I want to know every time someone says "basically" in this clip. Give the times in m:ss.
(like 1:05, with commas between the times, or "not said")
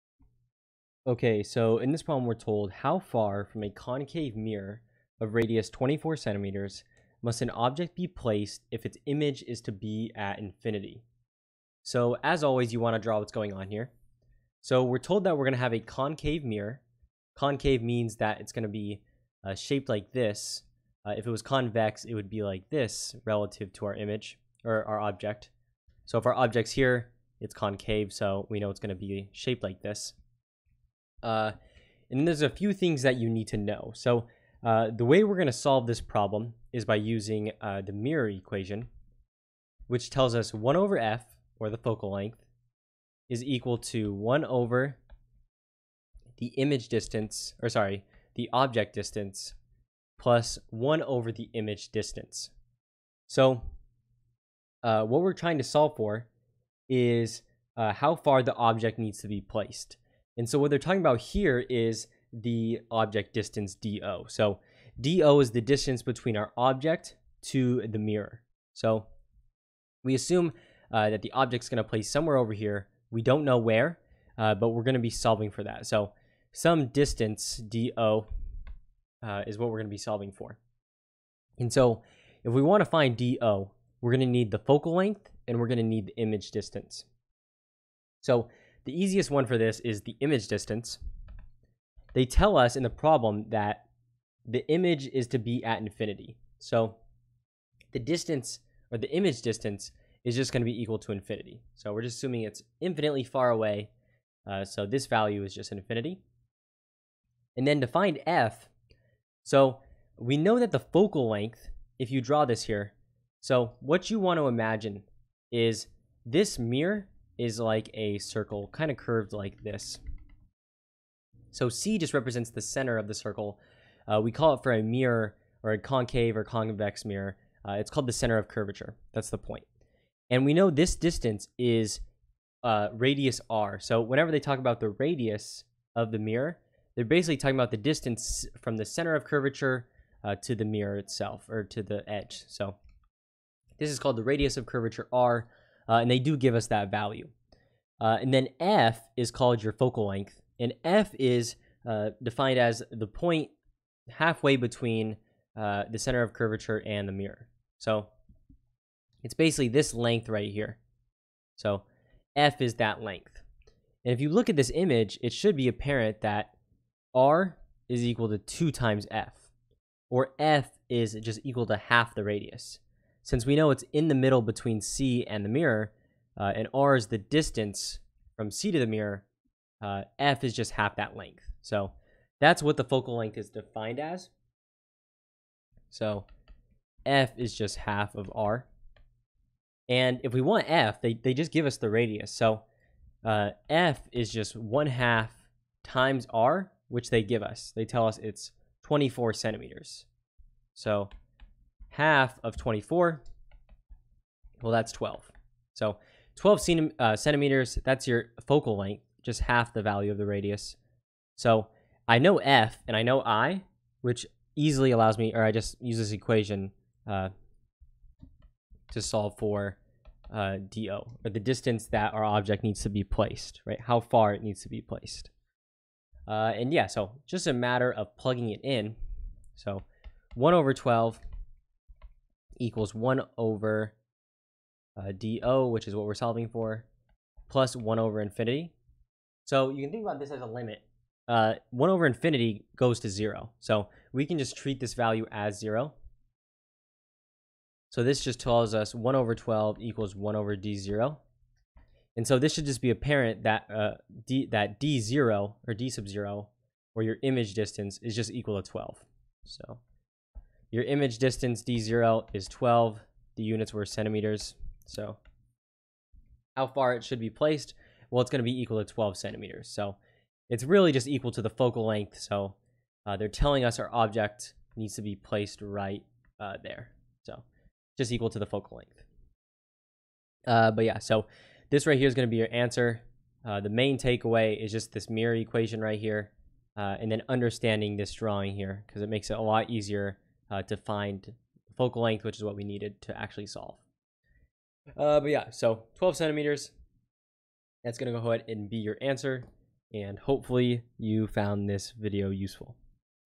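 2:17, 2:39.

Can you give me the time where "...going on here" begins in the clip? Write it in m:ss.
0:13.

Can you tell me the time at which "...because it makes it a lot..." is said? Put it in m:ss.
4:48.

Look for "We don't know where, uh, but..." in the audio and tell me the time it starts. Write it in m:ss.
1:13.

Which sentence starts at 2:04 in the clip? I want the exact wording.
Uh, we call it for a mirror or a concave or convex mirror.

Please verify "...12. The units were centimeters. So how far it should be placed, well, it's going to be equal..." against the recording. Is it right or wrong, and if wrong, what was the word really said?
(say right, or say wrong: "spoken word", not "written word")
right.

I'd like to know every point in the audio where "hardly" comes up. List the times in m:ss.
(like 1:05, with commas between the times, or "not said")
not said.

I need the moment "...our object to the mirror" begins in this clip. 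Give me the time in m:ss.
1:06.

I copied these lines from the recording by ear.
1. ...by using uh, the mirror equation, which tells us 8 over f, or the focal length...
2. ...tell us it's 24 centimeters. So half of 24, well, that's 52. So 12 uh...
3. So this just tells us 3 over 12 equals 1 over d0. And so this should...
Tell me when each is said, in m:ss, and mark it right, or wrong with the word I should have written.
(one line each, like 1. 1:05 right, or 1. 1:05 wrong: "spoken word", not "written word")
1. 0:36 wrong: "1", not "8"
2. 3:17 wrong: "12", not "52"
3. 4:07 wrong: "1", not "3".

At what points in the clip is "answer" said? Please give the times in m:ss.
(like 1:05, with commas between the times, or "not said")
4:42, 4:59.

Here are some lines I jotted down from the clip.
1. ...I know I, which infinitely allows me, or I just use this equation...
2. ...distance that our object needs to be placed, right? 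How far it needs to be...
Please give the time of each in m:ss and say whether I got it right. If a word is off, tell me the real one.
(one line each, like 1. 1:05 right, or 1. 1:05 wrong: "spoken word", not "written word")
1. 3:32 wrong: "easily", not "infinitely"
2. 3:41 right.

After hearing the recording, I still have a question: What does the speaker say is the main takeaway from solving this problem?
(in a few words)
the mirror equation.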